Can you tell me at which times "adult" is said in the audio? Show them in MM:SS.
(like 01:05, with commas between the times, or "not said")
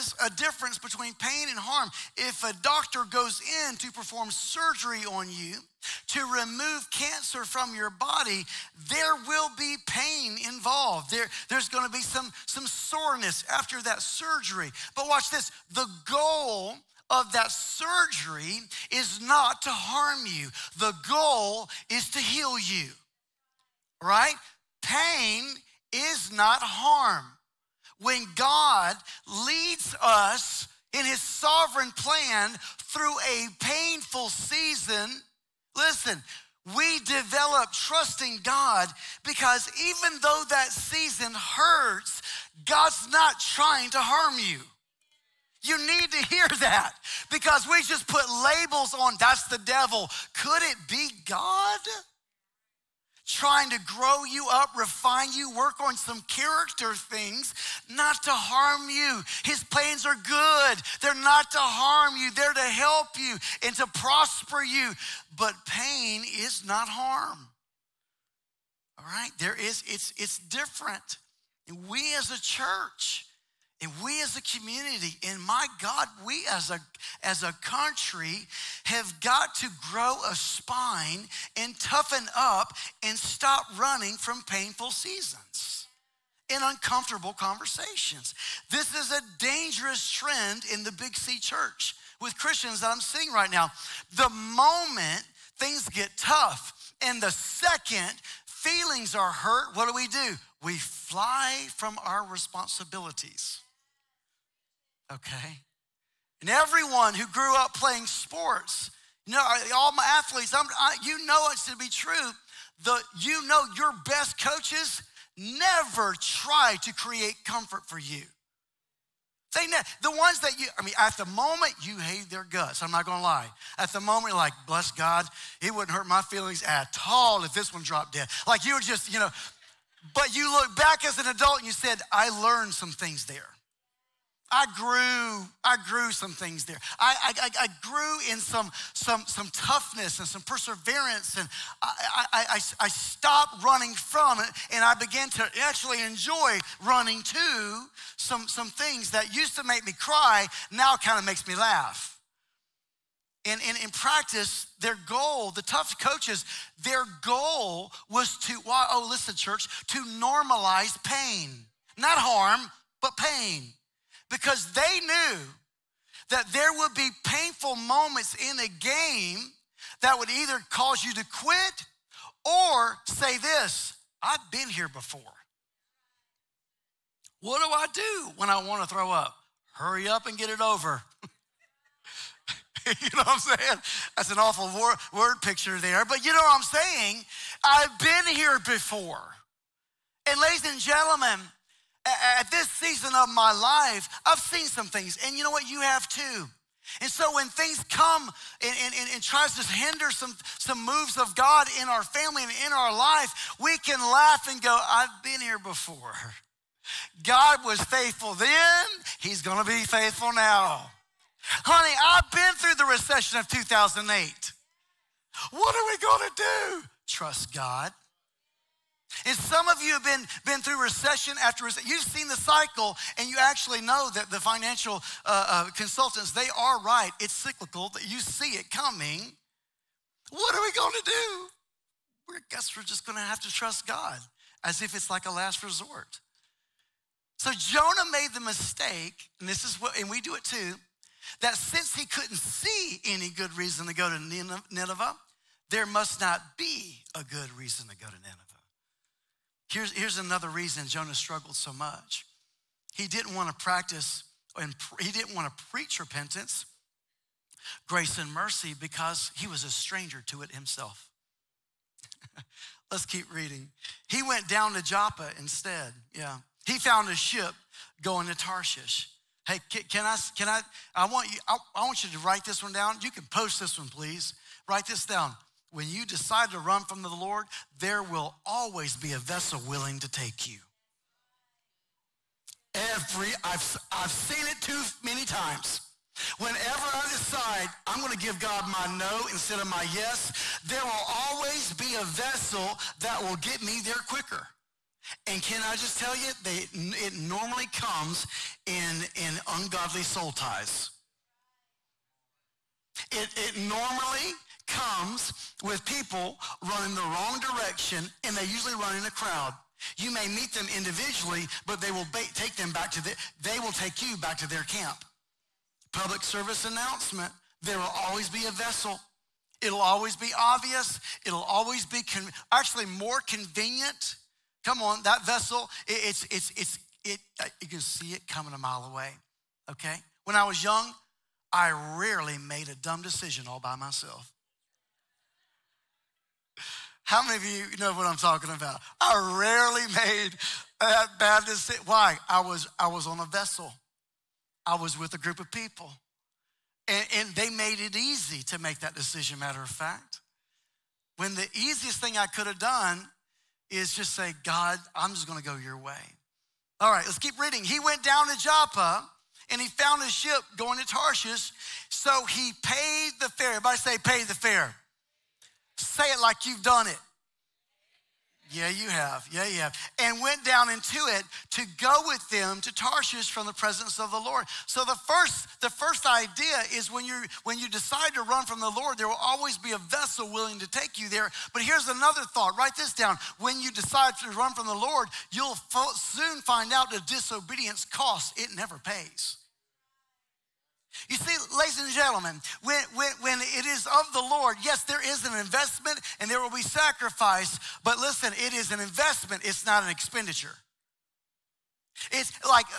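02:11.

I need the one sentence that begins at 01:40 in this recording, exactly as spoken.
We fly from our responsibilities okay?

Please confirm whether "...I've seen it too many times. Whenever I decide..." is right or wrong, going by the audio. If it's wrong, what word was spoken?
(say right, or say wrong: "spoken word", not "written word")
right.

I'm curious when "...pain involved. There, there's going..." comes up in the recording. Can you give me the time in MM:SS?
00:09.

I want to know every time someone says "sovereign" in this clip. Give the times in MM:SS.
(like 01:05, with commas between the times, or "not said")
00:31.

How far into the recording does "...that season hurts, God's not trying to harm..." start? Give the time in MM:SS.
00:40.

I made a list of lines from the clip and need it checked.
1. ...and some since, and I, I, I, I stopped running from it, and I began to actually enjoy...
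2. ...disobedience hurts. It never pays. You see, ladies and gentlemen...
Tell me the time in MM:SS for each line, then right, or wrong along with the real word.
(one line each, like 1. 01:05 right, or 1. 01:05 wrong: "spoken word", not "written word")
1. 02:20 wrong: "perseverance", not "since"
2. 06:27 wrong: "costs", not "hurts".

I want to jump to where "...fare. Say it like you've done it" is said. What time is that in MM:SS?
06:04.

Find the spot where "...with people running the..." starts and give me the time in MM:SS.
05:05.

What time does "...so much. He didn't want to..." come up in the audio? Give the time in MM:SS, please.
04:11.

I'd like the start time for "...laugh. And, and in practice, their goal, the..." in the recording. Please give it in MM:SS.
02:31.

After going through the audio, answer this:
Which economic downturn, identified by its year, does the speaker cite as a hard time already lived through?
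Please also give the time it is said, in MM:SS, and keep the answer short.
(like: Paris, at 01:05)
recession of 2008, at 03:32.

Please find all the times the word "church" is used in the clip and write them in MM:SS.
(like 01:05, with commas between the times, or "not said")
01:12, 01:31, 02:39.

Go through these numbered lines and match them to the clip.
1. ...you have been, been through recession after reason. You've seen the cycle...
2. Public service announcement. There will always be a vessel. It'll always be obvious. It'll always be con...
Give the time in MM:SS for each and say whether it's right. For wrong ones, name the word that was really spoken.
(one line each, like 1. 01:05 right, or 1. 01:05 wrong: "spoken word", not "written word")
1. 03:39 wrong: "recession", not "reason"
2. 05:15 right.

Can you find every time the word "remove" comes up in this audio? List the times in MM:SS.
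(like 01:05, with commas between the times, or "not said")
00:06.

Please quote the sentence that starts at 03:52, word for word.
We're, I guess we're just going to have to trust God as if it's like a last resort.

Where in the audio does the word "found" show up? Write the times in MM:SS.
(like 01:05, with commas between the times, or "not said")
04:26, 05:59.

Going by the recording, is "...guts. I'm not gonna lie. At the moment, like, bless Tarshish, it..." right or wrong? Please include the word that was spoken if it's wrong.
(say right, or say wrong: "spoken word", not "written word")
wrong: "God", not "Tarshish".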